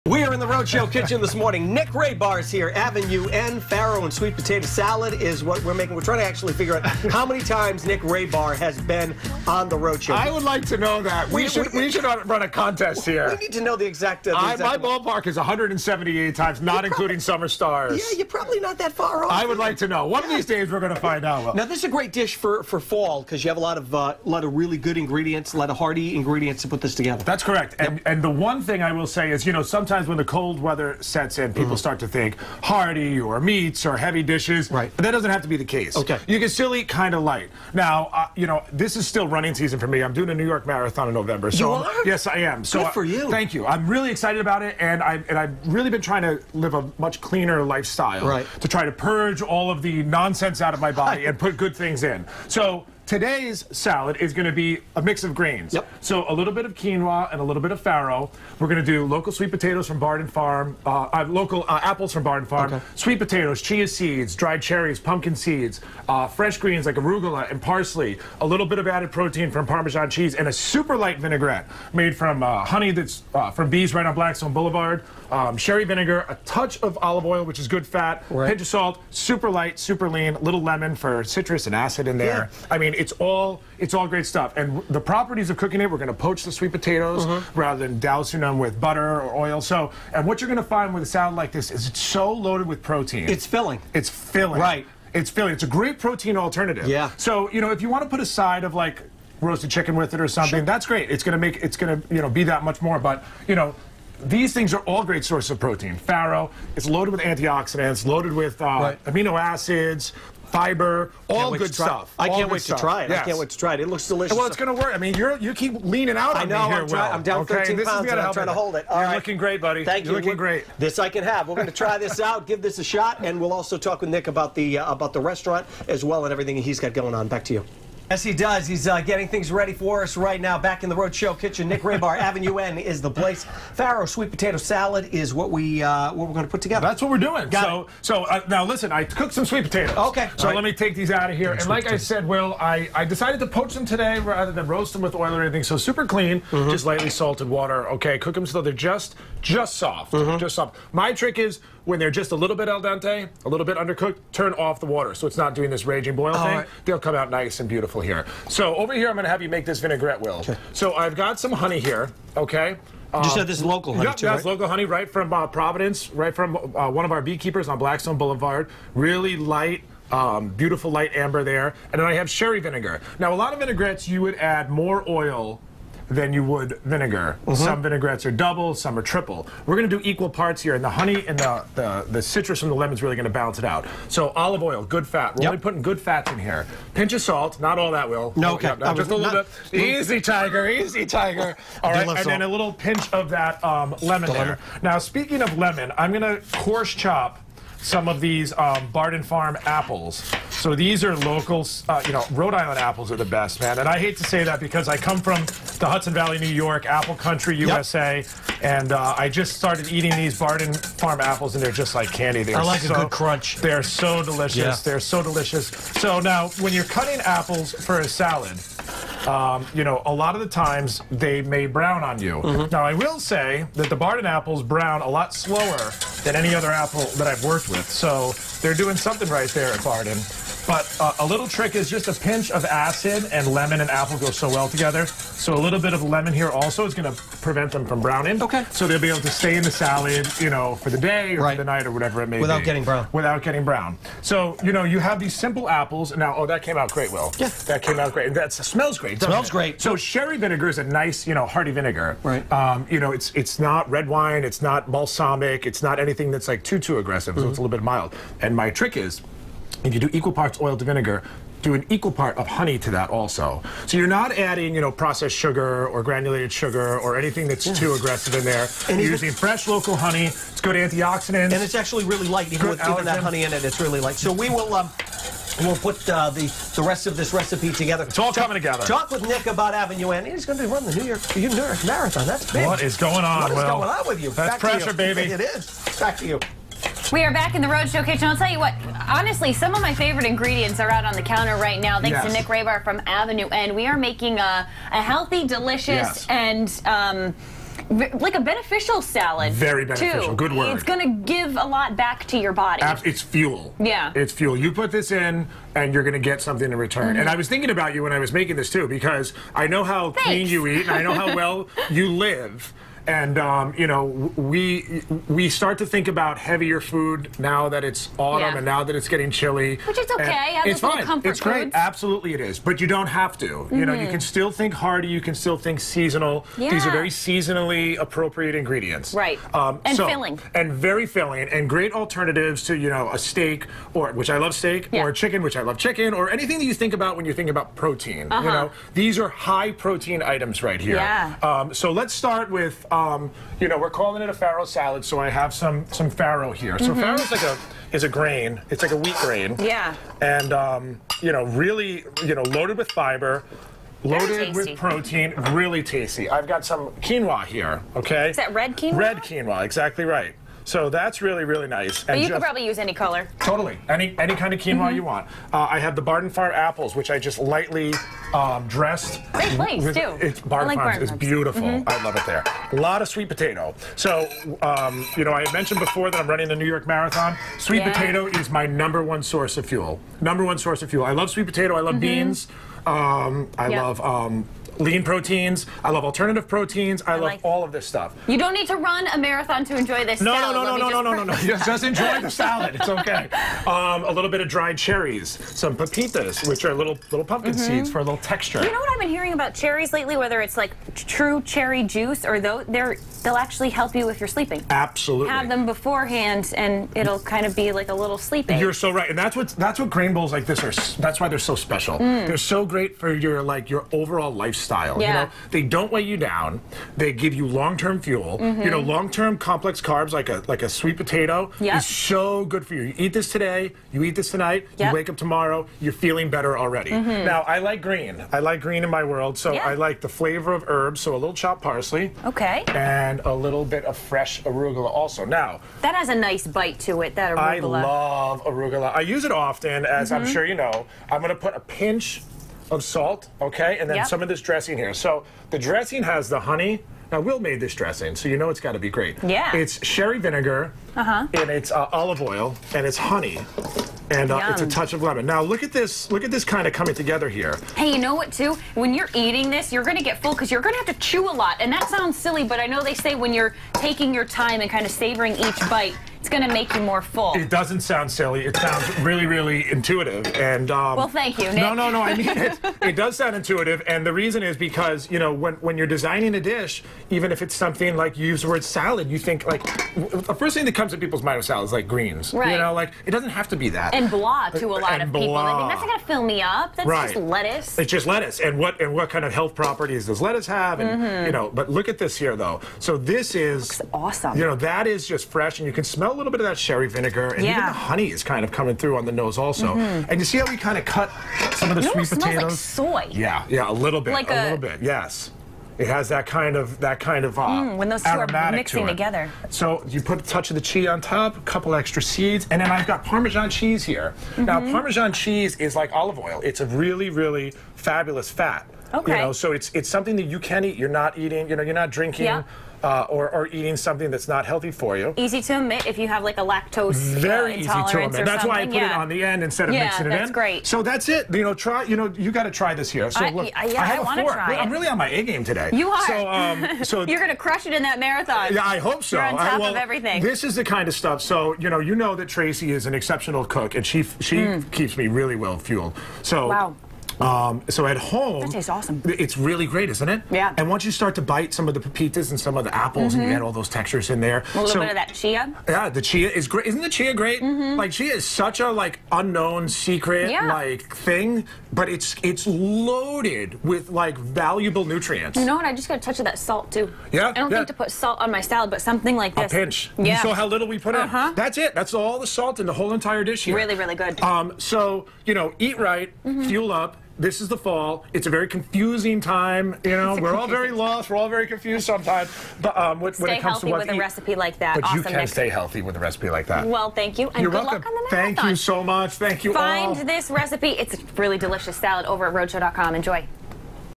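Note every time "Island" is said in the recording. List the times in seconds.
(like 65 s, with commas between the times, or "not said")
202 s.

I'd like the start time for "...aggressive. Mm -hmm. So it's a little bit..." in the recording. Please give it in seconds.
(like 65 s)
257 s.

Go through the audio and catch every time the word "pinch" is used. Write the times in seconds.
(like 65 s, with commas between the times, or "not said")
78 s, 186 s, 192 s, 232 s, 441 s, 569 s.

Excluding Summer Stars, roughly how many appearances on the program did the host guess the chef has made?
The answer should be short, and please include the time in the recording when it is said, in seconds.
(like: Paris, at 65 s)
178, at 15 s.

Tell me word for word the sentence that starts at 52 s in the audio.
So Today's salad is going to be a mix of grains.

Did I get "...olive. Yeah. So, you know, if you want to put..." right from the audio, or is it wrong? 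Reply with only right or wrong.
wrong.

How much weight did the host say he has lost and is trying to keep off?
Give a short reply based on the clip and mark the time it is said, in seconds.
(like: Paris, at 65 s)
13 pounds, at 117 s.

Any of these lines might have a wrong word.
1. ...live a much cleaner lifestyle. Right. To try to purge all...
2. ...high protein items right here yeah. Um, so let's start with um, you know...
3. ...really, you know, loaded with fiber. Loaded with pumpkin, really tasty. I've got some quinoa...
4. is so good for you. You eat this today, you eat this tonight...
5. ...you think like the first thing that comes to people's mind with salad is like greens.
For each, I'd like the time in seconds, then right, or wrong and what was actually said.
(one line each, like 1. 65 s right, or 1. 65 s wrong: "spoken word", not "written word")
1. 46 s right
2. 339 s right
3. 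351 s wrong: "protein", not "pumpkin"
4. 421 s right
5. 479 s right.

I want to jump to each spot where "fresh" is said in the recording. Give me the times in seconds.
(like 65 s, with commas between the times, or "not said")
66 s, 269 s, 434 s, 495 s.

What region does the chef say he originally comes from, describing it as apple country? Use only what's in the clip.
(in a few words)
Hudson Valley.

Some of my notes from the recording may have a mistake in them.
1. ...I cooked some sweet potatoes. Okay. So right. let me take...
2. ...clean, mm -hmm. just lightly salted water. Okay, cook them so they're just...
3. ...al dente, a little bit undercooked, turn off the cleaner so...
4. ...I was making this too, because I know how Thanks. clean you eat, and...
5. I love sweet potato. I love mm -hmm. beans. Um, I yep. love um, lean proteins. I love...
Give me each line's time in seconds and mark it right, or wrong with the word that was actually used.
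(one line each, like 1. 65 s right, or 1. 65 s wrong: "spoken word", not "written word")
1. 138 s right
2. 146 s right
3. 152 s wrong: "water", not "cleaner"
4. 308 s right
5. 381 s right.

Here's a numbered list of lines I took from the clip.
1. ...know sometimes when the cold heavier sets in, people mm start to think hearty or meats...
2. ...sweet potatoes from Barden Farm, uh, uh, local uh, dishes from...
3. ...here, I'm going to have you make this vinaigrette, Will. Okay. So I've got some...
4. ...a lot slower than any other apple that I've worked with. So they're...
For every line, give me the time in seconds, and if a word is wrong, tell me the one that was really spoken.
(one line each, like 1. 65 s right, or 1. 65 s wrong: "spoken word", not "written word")
1. 29 s wrong: "weather", not "heavier"
2. 59 s wrong: "apples", not "dishes"
3. 158 s right
4. 225 s right.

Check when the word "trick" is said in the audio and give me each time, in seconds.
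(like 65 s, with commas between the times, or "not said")
151 s, 231 s, 258 s.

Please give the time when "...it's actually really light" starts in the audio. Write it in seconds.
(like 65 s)
271 s.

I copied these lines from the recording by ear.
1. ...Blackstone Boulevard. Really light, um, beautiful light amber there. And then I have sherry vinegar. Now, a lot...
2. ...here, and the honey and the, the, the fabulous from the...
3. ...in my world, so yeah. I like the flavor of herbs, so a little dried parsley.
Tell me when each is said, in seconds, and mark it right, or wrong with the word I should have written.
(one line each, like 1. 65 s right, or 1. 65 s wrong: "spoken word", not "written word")
1. 167 s right
2. 180 s wrong: "citrus", not "fabulous"
3. 428 s wrong: "chopped", not "dried".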